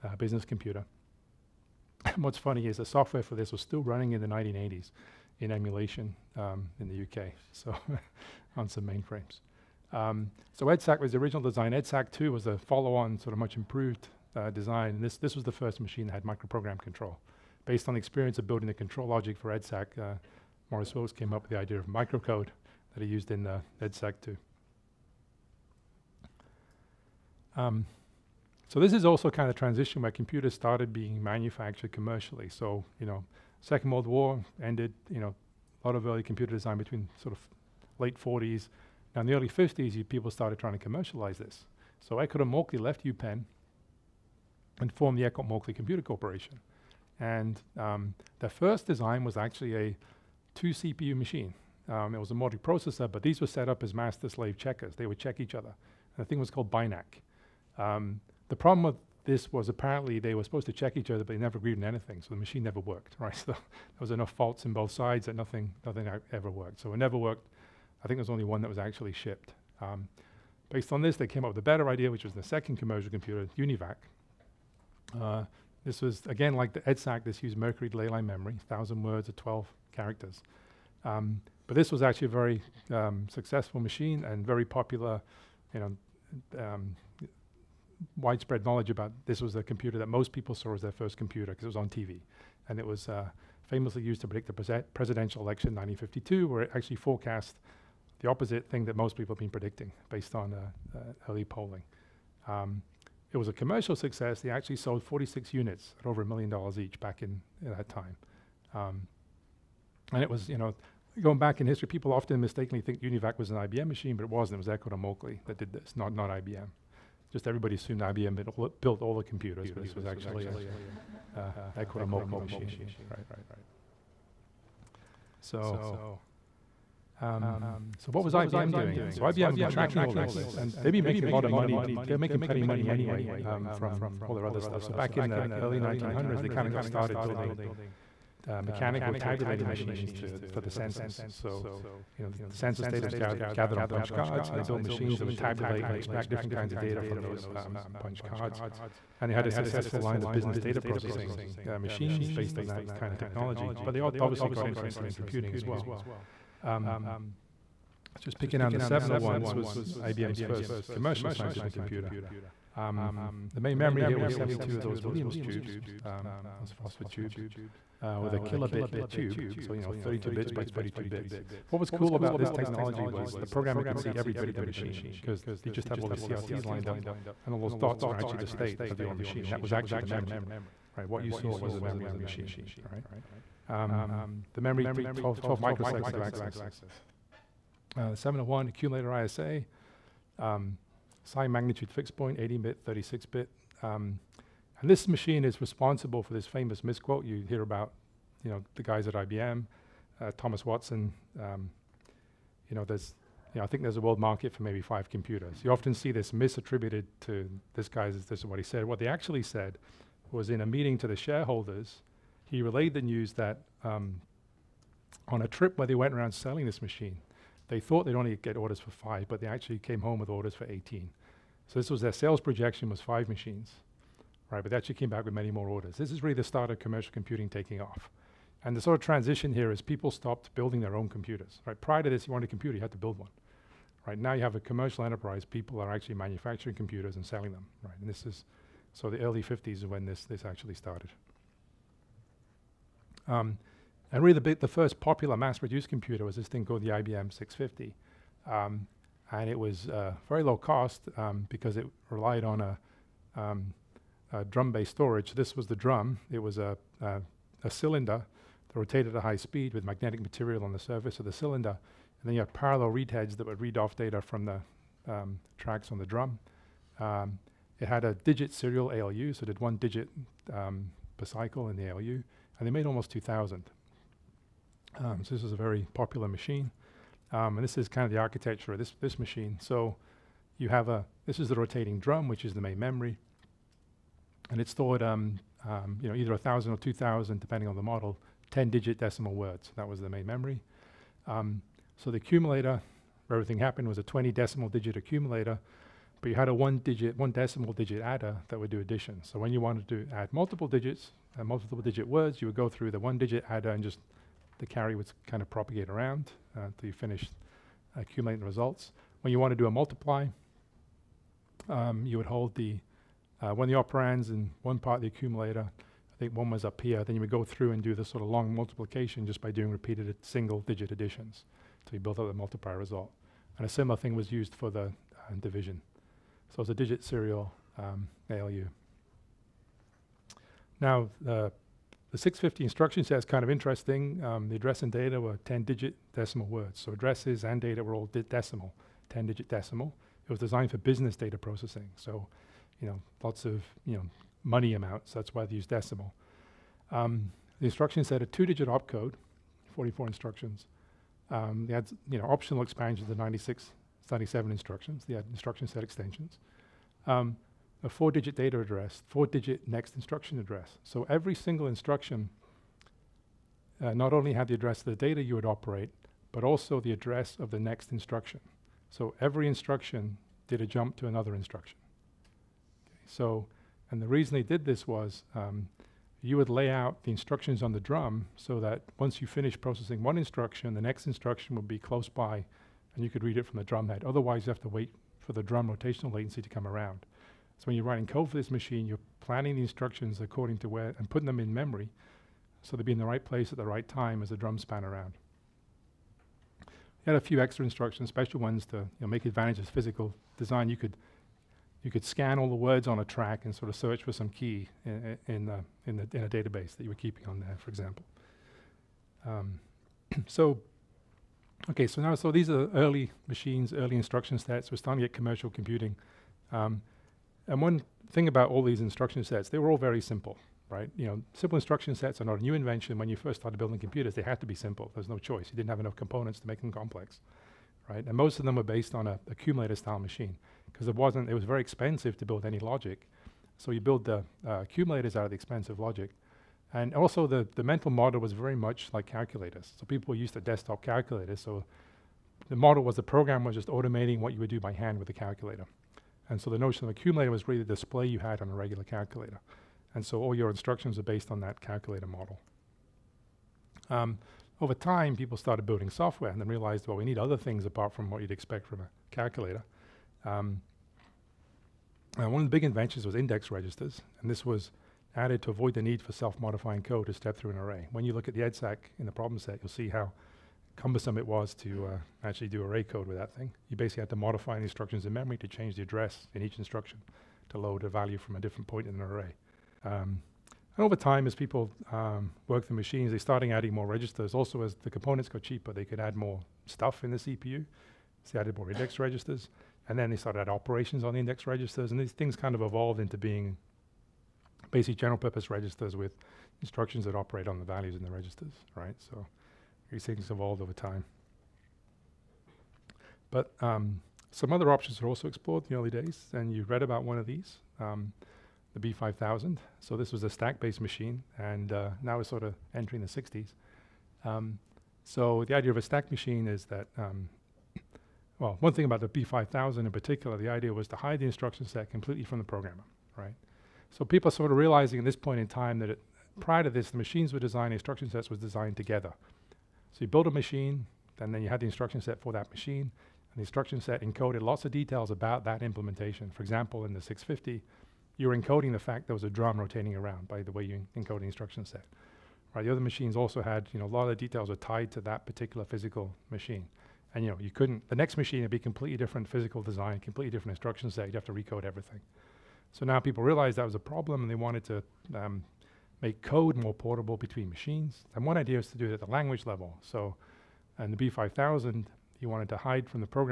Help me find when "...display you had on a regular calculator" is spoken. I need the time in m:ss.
7:27.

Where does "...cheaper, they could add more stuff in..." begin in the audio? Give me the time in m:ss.
8:05.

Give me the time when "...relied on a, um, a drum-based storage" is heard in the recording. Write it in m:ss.
4:12.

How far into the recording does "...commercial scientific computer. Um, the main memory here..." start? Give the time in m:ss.
2:40.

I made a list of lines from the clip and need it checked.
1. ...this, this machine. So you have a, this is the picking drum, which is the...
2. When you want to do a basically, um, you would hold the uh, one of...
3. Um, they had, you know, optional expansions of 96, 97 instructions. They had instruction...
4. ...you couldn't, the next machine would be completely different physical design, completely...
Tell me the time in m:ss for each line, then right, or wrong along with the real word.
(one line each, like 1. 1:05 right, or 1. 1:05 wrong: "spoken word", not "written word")
1. 4:38 wrong: "rotating", not "picking"
2. 5:09 wrong: "multiply", not "basically"
3. 5:51 right
4. 9:07 right.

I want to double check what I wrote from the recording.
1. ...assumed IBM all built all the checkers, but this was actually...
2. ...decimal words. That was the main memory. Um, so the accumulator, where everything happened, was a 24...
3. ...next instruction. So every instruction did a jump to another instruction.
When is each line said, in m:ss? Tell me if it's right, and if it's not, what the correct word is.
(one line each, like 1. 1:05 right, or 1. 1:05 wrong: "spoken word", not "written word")
1. 1:57 wrong: "computers", not "checkers"
2. 4:48 wrong: "20", not "24"
3. 6:07 right.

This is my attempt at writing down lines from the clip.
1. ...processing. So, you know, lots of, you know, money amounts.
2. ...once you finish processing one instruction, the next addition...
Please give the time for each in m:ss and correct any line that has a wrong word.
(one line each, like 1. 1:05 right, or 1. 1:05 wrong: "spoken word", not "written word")
1. 5:41 right
2. 6:18 wrong: "instruction", not "addition".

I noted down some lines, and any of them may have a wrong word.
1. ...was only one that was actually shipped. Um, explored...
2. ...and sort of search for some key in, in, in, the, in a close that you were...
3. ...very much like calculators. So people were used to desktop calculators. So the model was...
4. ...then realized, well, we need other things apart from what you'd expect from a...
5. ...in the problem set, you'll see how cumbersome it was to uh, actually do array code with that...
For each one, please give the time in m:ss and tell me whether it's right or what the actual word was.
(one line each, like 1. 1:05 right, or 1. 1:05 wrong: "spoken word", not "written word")
1. 1:08 wrong: "based", not "explored"
2. 6:43 wrong: "database", not "close"
3. 7:18 right
4. 7:36 right
5. 7:48 right.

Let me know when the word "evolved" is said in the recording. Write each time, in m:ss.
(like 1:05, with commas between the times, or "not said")
8:12, 8:20.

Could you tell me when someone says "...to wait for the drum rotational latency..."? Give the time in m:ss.
6:24.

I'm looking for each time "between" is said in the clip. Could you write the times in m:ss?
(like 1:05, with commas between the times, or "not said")
0:36, 9:17.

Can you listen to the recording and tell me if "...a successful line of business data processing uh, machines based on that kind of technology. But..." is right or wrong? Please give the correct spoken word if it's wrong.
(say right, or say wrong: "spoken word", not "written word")
right.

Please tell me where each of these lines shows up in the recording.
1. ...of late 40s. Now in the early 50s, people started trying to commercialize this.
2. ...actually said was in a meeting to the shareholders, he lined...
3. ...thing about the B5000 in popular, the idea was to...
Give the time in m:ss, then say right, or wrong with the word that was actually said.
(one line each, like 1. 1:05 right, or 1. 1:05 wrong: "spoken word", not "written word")
1. 0:37 right
2. 3:29 wrong: "relayed", not "lined"
3. 8:38 wrong: "particular", not "popular".